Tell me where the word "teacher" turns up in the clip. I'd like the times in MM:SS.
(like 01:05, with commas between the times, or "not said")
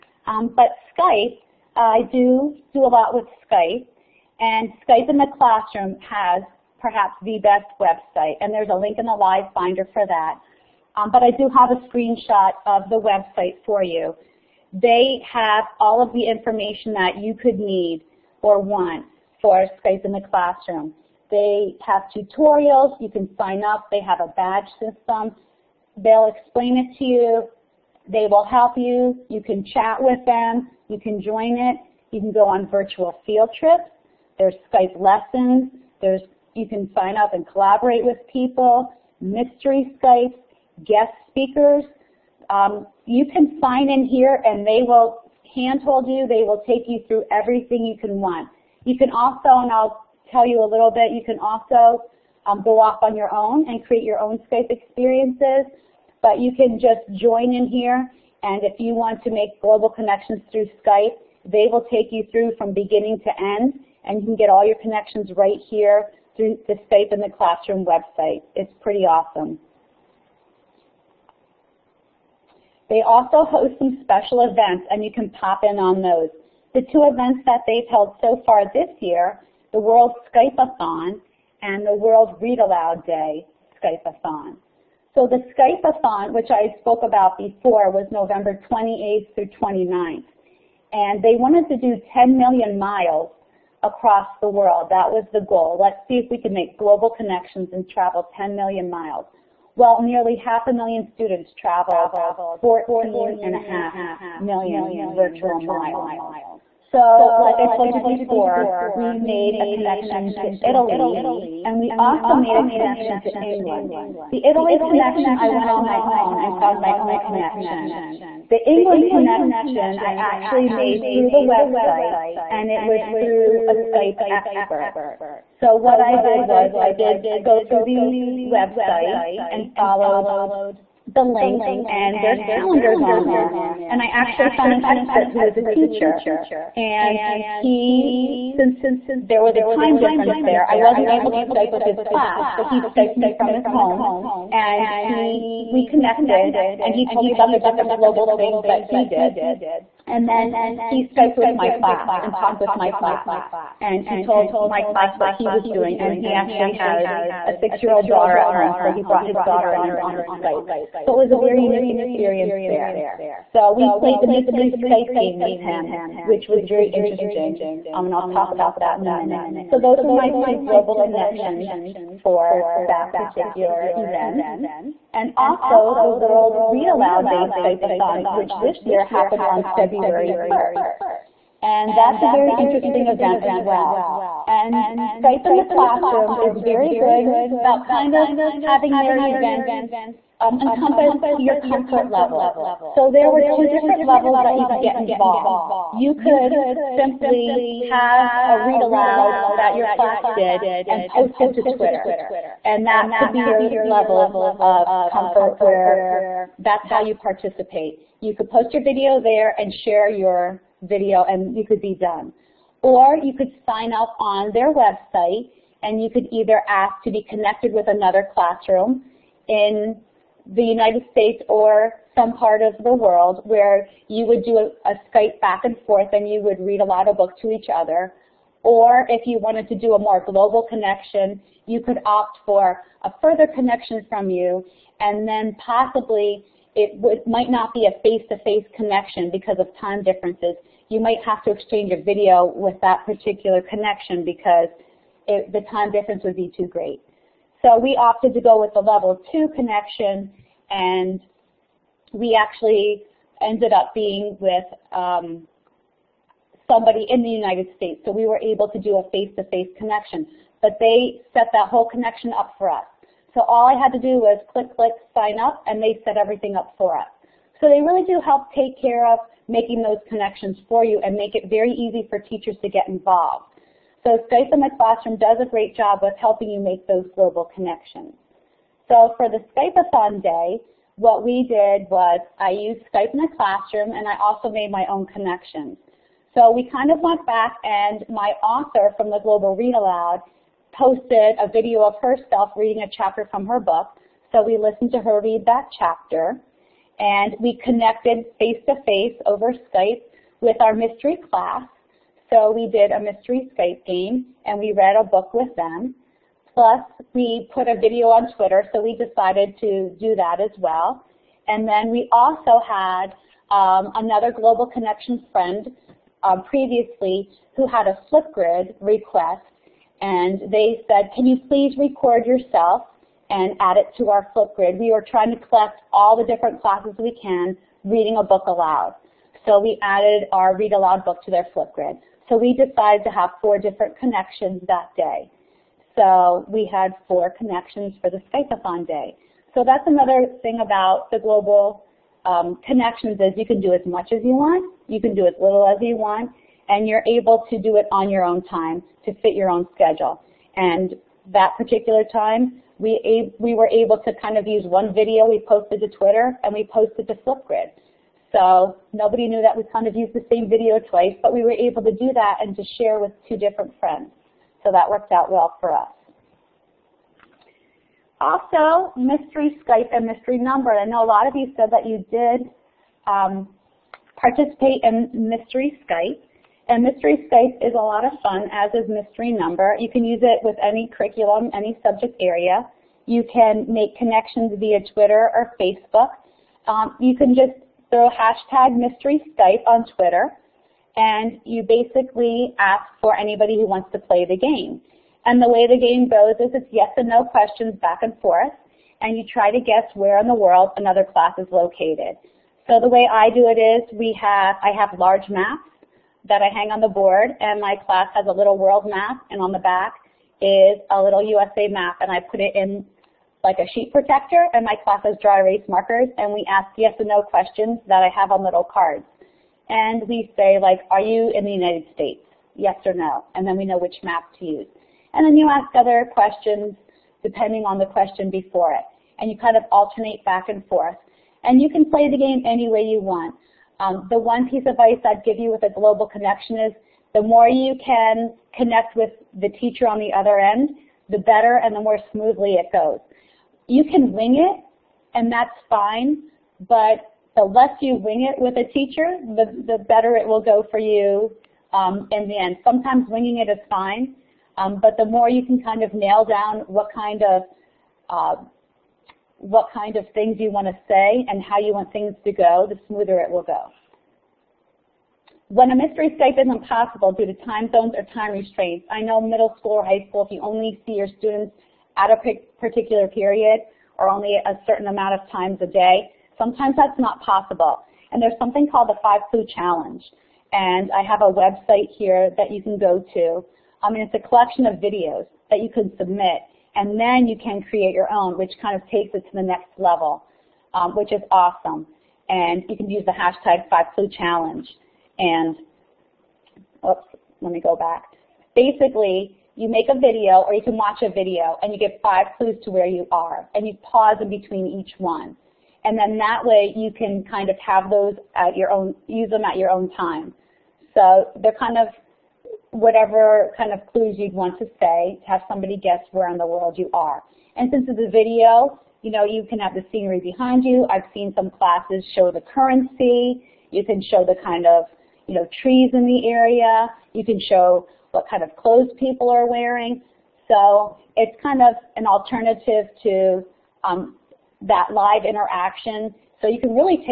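02:15, 04:32, 07:19, 07:28.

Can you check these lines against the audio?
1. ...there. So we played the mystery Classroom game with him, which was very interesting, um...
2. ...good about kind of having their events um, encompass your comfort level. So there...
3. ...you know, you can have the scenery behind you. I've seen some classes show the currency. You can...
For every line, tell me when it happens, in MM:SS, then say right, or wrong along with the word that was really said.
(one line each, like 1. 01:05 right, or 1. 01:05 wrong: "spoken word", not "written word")
1. 02:42 wrong: "Skype", not "Classroom"
2. 03:06 right
3. 08:39 right.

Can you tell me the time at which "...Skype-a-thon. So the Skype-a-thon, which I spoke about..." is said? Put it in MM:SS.
01:23.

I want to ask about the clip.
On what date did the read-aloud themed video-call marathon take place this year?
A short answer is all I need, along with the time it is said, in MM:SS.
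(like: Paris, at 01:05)
February 1st, at 02:59.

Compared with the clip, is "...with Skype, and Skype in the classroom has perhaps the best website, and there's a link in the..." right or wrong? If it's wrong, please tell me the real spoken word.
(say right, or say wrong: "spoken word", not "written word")
right.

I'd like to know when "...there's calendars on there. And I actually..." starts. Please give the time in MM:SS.
02:12.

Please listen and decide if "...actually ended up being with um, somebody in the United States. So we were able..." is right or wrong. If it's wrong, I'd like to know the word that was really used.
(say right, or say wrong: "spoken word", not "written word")
right.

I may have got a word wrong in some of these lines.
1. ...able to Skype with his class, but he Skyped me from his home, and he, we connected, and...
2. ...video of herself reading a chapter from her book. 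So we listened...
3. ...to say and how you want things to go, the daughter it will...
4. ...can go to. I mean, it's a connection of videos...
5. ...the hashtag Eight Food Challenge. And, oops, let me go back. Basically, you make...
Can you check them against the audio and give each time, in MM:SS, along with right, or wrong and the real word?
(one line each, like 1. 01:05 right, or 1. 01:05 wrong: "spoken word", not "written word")
1. 02:21 right
2. 04:51 right
3. 07:40 wrong: "smoother", not "daughter"
4. 08:02 wrong: "collection", not "connection"
5. 08:13 wrong: "Five", not "Eight".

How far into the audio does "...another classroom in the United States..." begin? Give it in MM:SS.
03:37.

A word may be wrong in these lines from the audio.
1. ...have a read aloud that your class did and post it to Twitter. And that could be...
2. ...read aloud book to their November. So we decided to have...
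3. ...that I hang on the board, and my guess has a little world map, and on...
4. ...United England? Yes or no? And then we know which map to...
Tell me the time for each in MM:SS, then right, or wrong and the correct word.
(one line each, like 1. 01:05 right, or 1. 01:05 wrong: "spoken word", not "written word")
1. 03:17 right
2. 05:30 wrong: "Flipgrid", not "November"
3. 06:46 wrong: "class", not "guess"
4. 07:01 wrong: "States", not "England".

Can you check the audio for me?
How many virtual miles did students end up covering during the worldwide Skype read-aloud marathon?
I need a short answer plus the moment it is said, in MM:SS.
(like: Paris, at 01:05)
14.5 million, at 01:42.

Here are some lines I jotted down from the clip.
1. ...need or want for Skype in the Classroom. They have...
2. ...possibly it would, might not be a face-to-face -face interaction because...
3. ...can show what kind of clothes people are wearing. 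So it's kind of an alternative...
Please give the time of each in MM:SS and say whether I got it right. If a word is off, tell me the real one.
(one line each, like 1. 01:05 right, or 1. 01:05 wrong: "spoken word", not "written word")
1. 00:17 right
2. 03:55 wrong: "connection", not "interaction"
3. 08:47 right.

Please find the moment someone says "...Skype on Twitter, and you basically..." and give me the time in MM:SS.
06:29.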